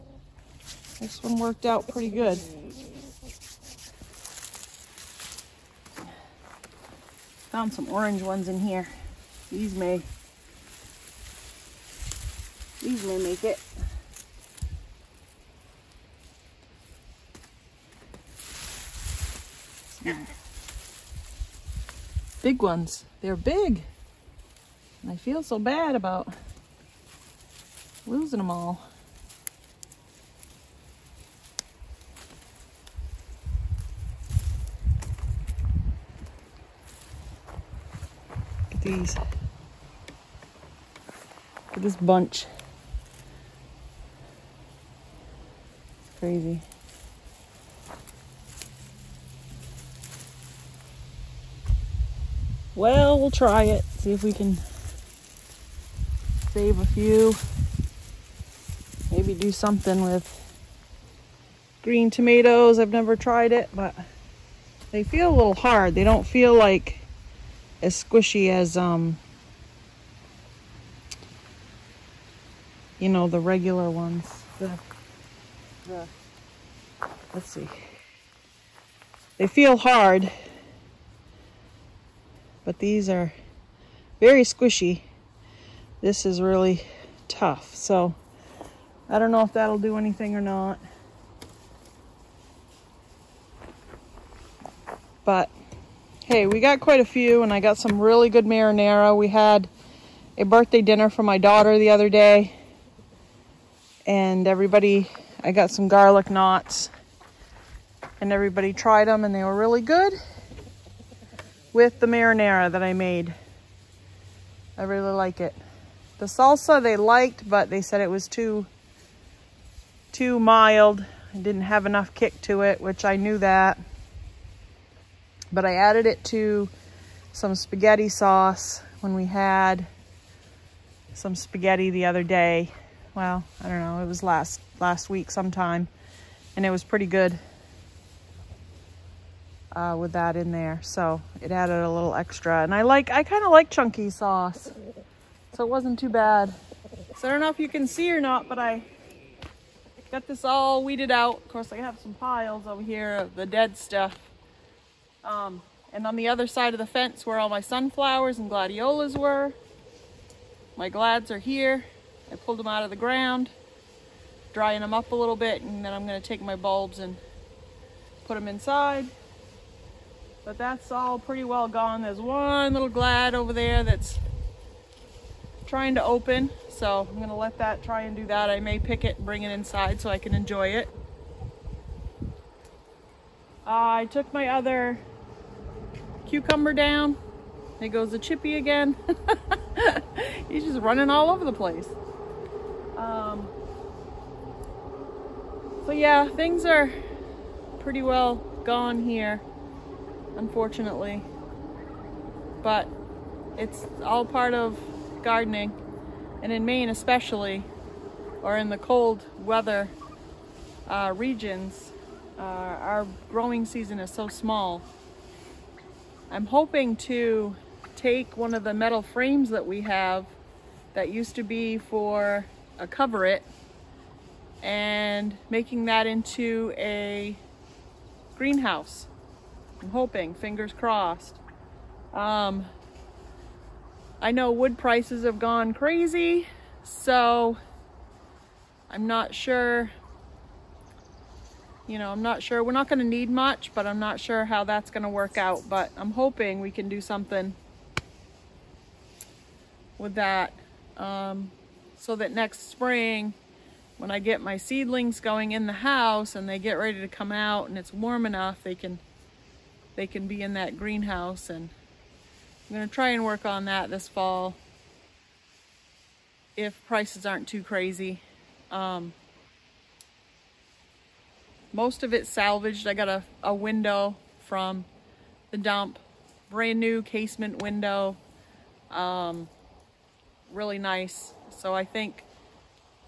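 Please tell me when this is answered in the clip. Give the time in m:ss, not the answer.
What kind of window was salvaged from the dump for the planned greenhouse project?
4:37.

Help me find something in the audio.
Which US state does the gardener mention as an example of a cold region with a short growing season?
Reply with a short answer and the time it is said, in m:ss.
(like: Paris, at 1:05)
Maine, at 3:26.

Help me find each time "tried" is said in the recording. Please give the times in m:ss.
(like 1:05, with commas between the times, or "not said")
1:03, 1:48.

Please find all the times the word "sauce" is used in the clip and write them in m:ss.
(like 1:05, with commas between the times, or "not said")
2:08, 2:24.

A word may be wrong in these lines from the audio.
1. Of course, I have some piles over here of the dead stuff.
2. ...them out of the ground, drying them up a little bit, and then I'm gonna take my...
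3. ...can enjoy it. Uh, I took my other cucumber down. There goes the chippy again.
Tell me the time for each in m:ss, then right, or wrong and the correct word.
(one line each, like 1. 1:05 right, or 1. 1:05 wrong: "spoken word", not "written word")
1. 2:31 right
2. 2:42 right
3. 3:00 right.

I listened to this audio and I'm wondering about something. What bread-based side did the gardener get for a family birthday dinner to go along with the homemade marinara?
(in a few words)
garlic knots.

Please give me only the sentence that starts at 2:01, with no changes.
It didn't have enough kick to it, which I knew that.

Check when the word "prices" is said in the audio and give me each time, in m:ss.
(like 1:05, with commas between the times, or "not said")
3:54, 4:26.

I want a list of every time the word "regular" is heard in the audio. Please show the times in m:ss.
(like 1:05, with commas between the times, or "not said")
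1:13.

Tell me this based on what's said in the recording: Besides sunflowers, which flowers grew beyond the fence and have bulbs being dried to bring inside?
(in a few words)
gladiolas.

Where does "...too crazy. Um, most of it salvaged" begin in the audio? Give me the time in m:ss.
4:27.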